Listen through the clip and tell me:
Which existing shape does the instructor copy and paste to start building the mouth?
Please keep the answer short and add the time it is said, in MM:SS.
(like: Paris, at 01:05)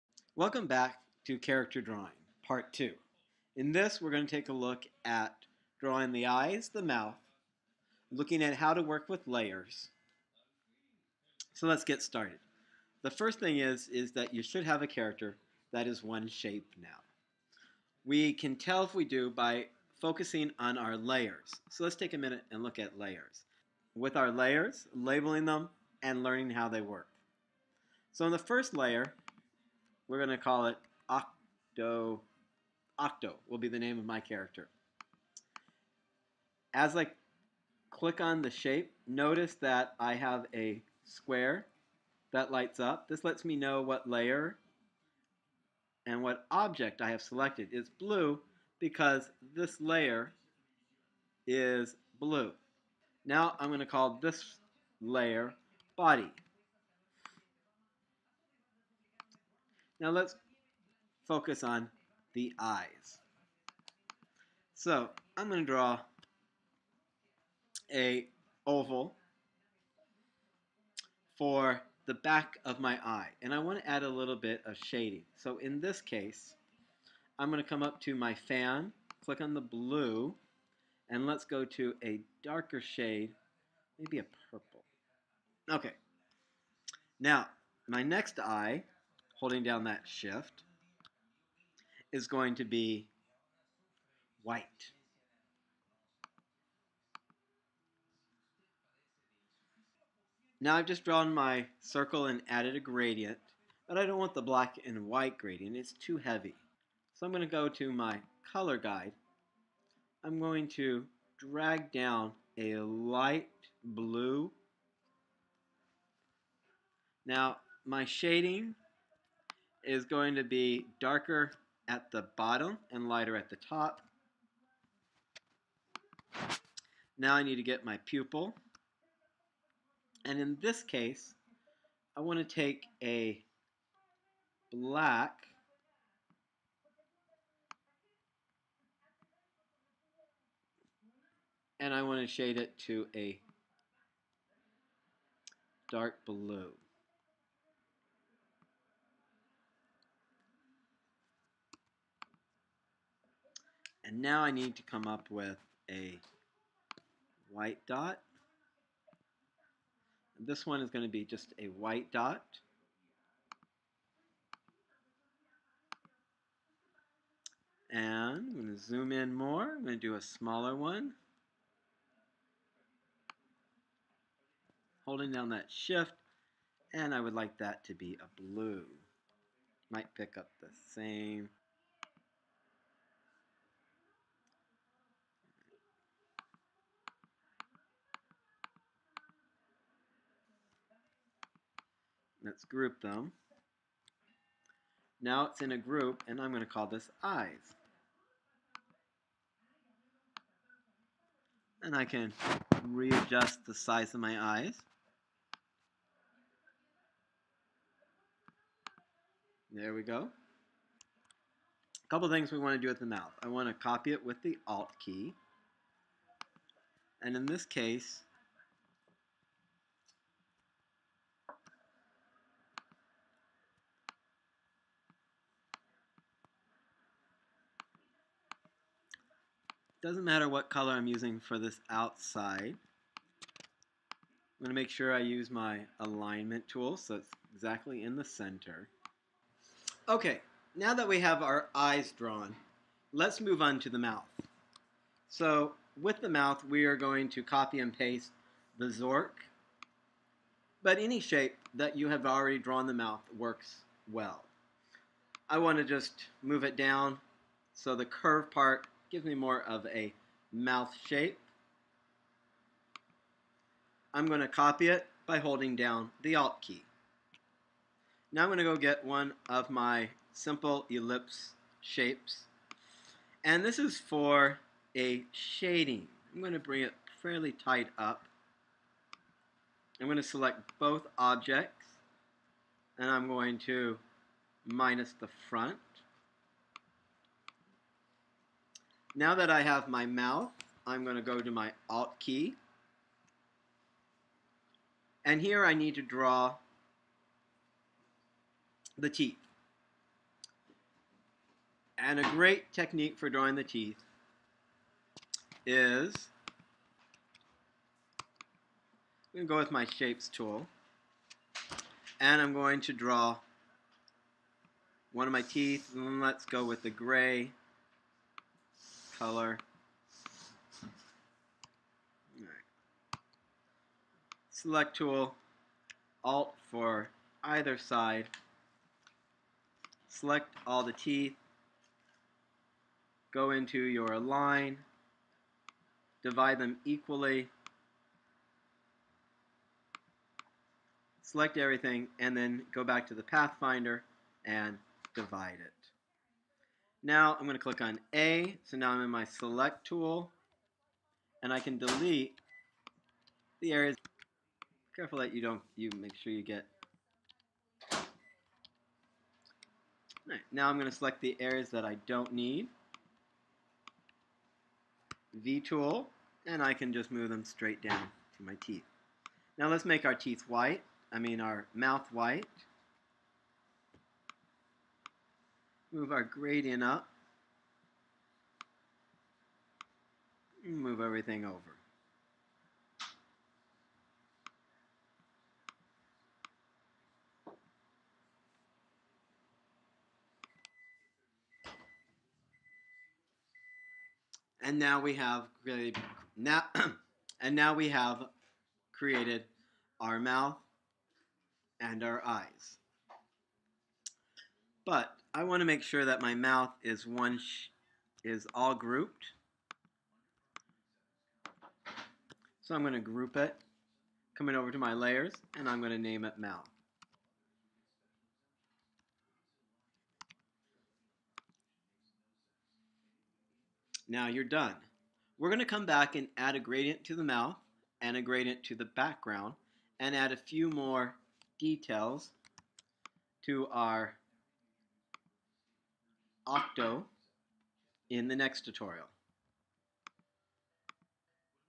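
the Zork, at 04:08.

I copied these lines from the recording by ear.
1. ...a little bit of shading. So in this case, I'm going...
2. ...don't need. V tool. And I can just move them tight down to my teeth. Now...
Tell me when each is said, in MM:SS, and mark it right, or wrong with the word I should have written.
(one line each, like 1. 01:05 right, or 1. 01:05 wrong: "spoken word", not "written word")
1. 01:14 right
2. 06:02 wrong: "straight", not "tight".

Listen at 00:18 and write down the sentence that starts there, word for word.
We can tell if we do by focusing on our layers.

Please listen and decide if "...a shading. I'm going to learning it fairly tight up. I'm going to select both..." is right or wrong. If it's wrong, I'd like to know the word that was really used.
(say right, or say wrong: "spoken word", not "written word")
wrong: "bring", not "learning".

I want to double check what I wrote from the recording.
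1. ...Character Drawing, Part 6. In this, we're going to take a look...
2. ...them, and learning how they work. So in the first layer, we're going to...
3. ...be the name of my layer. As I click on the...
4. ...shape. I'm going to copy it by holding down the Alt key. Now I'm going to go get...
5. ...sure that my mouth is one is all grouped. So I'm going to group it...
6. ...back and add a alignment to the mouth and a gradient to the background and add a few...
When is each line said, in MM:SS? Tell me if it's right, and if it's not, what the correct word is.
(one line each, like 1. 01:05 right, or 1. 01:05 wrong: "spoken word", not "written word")
1. 00:01 wrong: "2", not "6"
2. 00:25 right
3. 00:33 wrong: "character", not "layer"
4. 04:21 right
5. 06:45 right
6. 07:05 wrong: "gradient", not "alignment".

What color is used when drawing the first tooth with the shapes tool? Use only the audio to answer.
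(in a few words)
gray.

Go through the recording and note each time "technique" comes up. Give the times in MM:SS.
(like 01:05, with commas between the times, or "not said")
05:02.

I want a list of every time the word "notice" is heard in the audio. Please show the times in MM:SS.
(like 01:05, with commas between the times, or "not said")
00:39.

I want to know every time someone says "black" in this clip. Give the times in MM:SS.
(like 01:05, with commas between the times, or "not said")
01:44, 02:14.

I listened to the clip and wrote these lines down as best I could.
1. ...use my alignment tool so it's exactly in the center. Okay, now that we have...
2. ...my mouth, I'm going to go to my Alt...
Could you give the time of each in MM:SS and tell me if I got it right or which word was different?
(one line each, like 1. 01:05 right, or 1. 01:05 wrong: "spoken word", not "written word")
1. 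03:55 right
2. 04:49 right.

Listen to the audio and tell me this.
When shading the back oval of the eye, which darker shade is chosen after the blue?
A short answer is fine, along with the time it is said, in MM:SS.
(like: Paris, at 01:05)
purple, at 01:24.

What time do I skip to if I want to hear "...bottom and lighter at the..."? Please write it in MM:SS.
02:02.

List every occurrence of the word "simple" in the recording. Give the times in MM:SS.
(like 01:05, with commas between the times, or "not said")
04:30.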